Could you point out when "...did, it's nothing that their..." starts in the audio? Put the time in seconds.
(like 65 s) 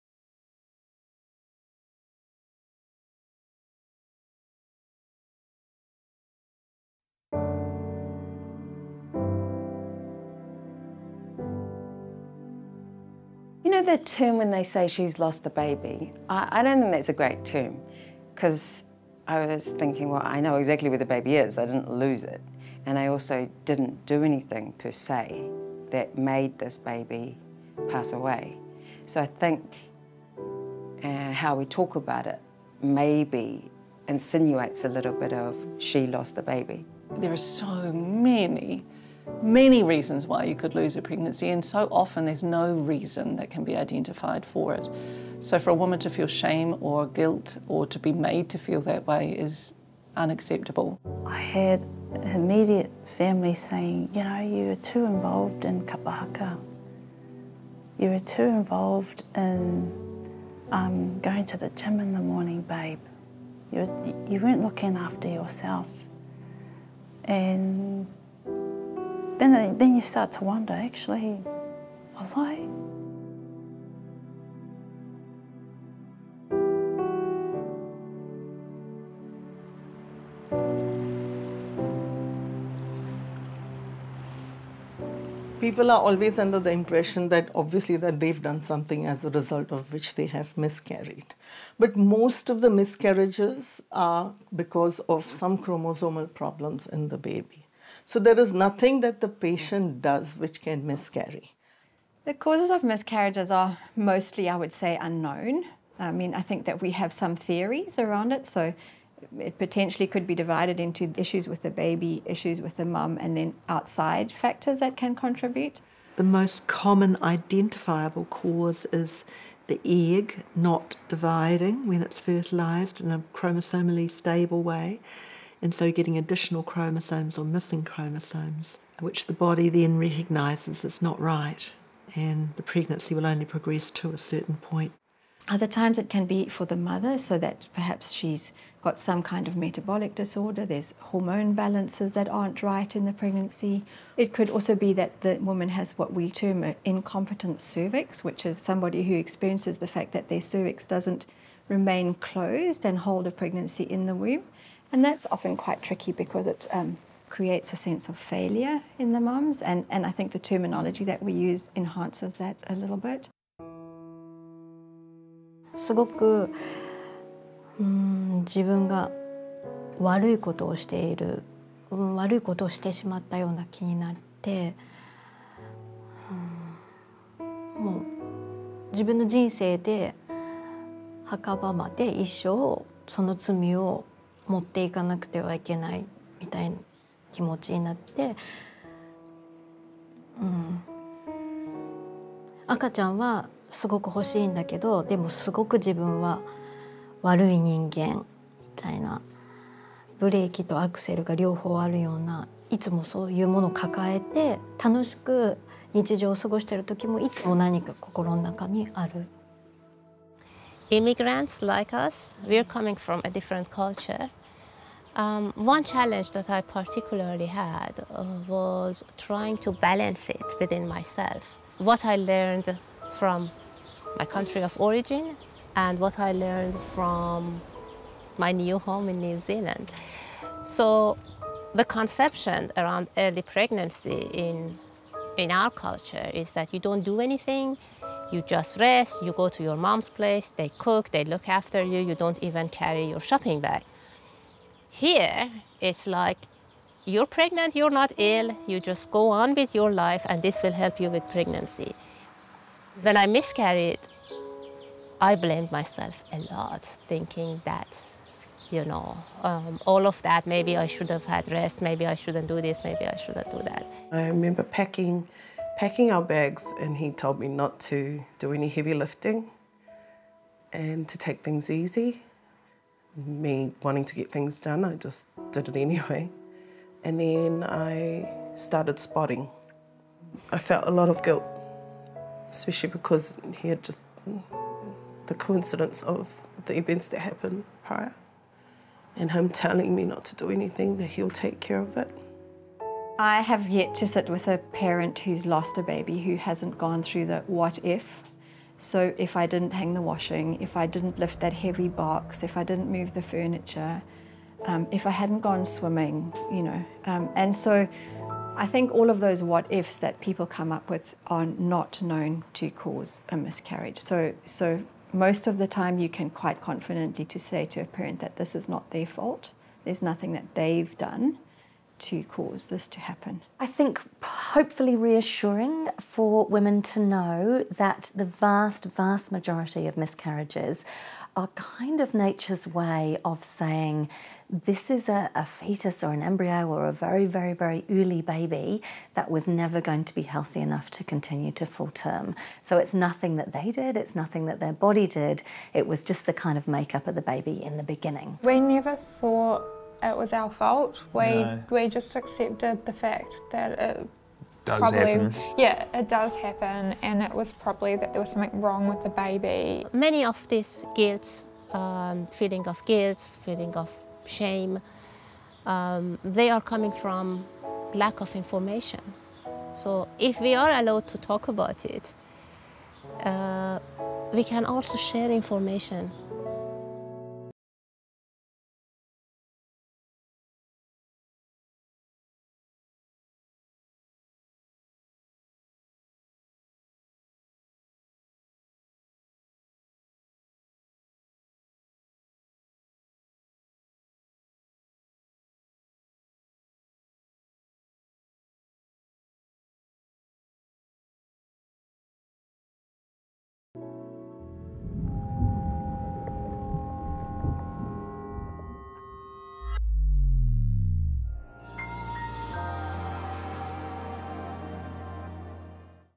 343 s.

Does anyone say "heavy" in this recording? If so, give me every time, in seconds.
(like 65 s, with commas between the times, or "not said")
268 s, 301 s.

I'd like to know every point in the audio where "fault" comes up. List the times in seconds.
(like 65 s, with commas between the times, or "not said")
319 s, 350 s.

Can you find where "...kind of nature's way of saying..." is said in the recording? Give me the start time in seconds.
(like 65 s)
331 s.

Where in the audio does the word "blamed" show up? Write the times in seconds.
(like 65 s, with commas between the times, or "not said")
255 s.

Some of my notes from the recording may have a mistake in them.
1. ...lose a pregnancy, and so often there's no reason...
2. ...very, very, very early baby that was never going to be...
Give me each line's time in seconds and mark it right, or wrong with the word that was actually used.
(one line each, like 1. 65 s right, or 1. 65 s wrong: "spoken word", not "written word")
1. 40 s right
2. 336 s right.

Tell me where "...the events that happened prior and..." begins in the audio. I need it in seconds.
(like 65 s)
286 s.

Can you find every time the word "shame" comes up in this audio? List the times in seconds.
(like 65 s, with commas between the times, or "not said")
46 s, 364 s.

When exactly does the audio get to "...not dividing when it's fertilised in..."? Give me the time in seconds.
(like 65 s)
120 s.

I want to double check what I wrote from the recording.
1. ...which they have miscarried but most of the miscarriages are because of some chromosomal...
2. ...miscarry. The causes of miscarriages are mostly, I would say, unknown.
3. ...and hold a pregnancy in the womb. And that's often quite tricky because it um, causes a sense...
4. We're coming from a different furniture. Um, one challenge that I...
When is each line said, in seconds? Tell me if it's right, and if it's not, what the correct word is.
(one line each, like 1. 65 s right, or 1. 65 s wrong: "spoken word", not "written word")
1. 89 s right
2. 100 s right
3. 152 s wrong: "creates", not "causes"
4. 212 s wrong: "culture", not "furniture".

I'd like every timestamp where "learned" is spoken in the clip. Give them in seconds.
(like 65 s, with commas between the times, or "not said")
222 s, 226 s.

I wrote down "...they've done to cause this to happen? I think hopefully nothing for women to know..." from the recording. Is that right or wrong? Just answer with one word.
wrong.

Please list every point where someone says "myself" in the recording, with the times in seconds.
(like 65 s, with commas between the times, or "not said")
220 s, 255 s.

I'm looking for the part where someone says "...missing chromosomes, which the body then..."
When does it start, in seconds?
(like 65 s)
127 s.